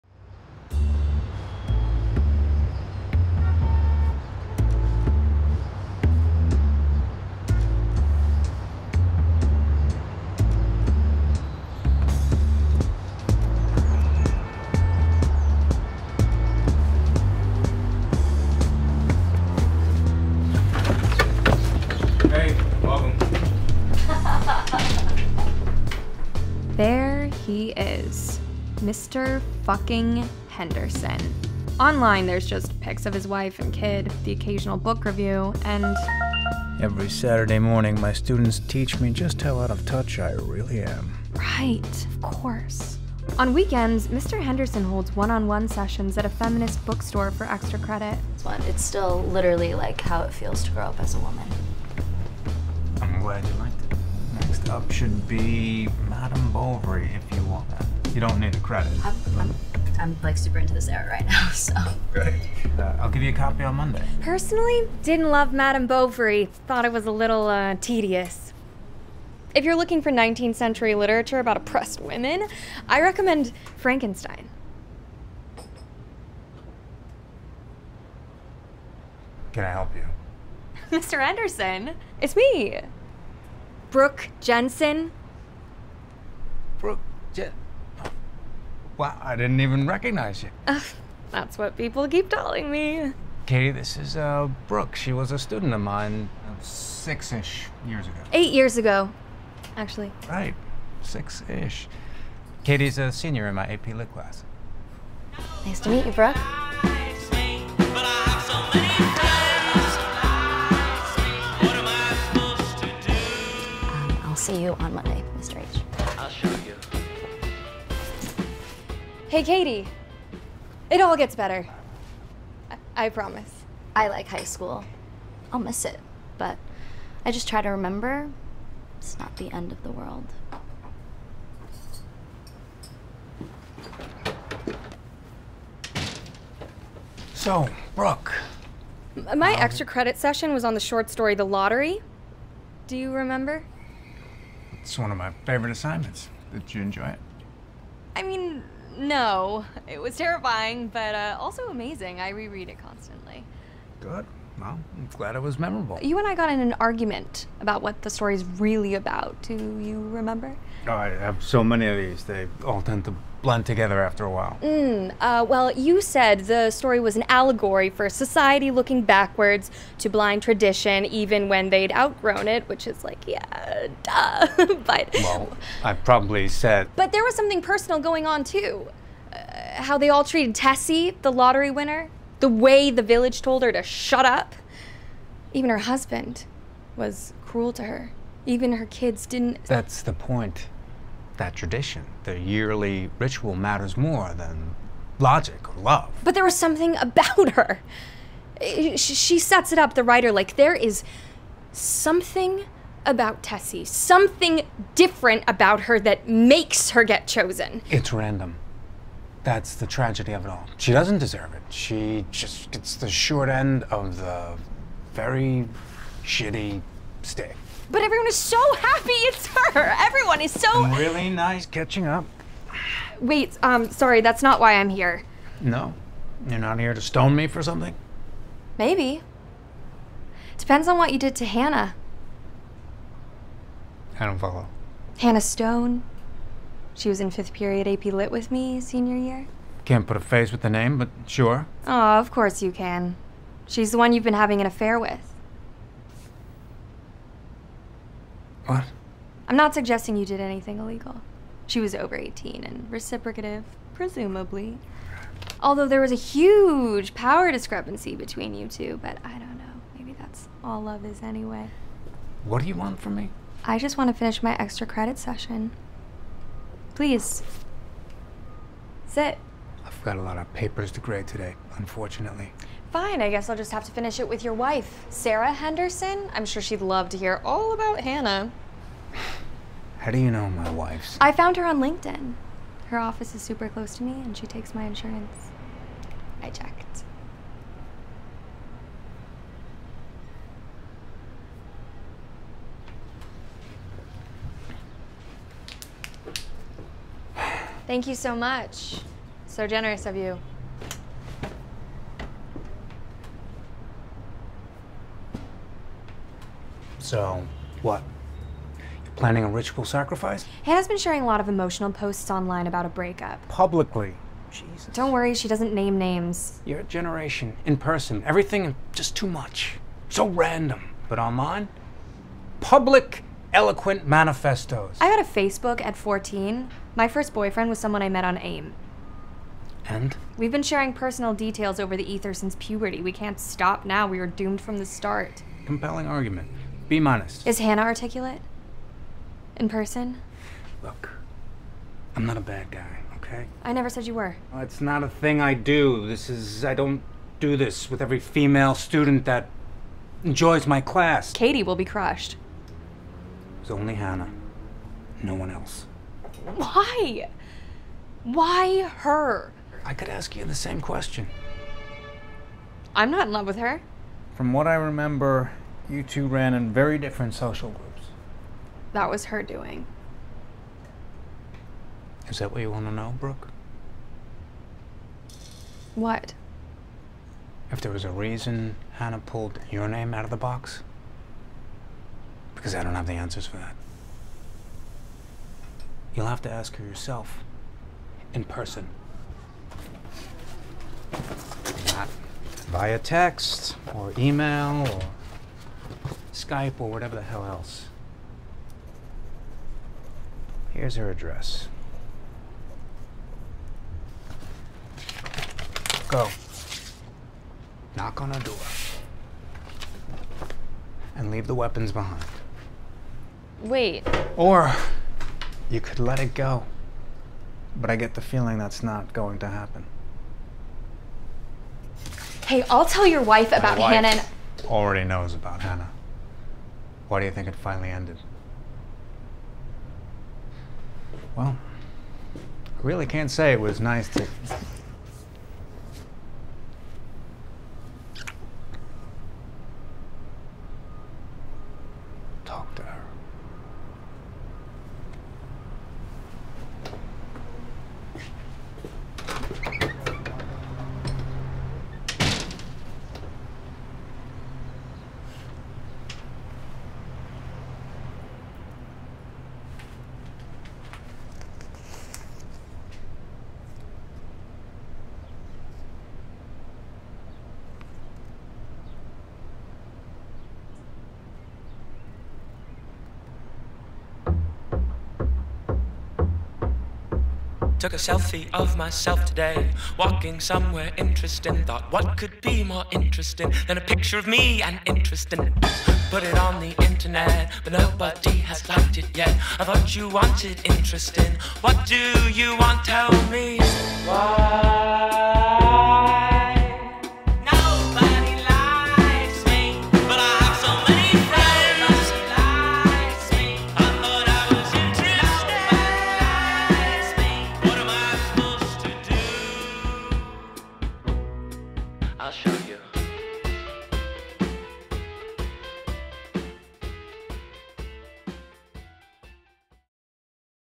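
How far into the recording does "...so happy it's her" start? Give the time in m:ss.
3:38.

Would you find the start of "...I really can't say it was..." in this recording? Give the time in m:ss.
7:12.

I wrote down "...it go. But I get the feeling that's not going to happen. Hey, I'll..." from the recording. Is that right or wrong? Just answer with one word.
right.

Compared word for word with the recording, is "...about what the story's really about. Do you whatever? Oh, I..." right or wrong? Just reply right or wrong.
wrong.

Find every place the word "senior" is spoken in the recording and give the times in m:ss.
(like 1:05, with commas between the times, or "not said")
1:43, 3:58.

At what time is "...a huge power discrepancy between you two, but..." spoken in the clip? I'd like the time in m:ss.
4:16.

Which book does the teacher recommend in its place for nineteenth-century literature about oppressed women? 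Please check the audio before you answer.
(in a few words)
Frankenstein.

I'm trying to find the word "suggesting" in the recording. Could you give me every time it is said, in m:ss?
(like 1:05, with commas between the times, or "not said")
4:09.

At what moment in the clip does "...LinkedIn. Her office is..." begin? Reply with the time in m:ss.
4:41.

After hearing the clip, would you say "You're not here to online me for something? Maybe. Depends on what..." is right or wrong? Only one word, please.
wrong.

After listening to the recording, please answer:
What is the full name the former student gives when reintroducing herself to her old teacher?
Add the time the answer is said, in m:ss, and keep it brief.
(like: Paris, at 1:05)
Brooke Jensen, at 1:23.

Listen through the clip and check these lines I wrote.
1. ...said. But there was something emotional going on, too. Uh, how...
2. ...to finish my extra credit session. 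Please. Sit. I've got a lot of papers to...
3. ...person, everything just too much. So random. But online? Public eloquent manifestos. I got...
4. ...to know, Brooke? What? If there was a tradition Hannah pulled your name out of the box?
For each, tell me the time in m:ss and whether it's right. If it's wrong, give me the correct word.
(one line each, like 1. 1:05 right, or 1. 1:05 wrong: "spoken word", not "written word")
1. 2:56 wrong: "personal", not "emotional"
2. 4:24 right
3. 5:17 right
4. 6:12 wrong: "reason", not "tradition".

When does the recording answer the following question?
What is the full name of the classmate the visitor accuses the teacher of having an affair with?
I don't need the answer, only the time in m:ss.
3:55.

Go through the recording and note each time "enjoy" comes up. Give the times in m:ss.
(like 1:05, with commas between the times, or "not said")
2:26, 5:50.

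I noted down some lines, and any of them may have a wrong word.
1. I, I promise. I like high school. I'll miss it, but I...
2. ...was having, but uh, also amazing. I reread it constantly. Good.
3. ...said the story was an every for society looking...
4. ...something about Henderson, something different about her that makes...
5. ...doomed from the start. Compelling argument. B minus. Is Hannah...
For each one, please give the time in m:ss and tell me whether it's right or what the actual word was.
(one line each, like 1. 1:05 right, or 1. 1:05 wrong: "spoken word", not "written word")
1. 2:02 right
2. 2:29 wrong: "terrifying", not "having"
3. 2:45 wrong: "allegory", not "every"
4. 3:21 wrong: "Tessie", not "Henderson"
5. 5:34 right.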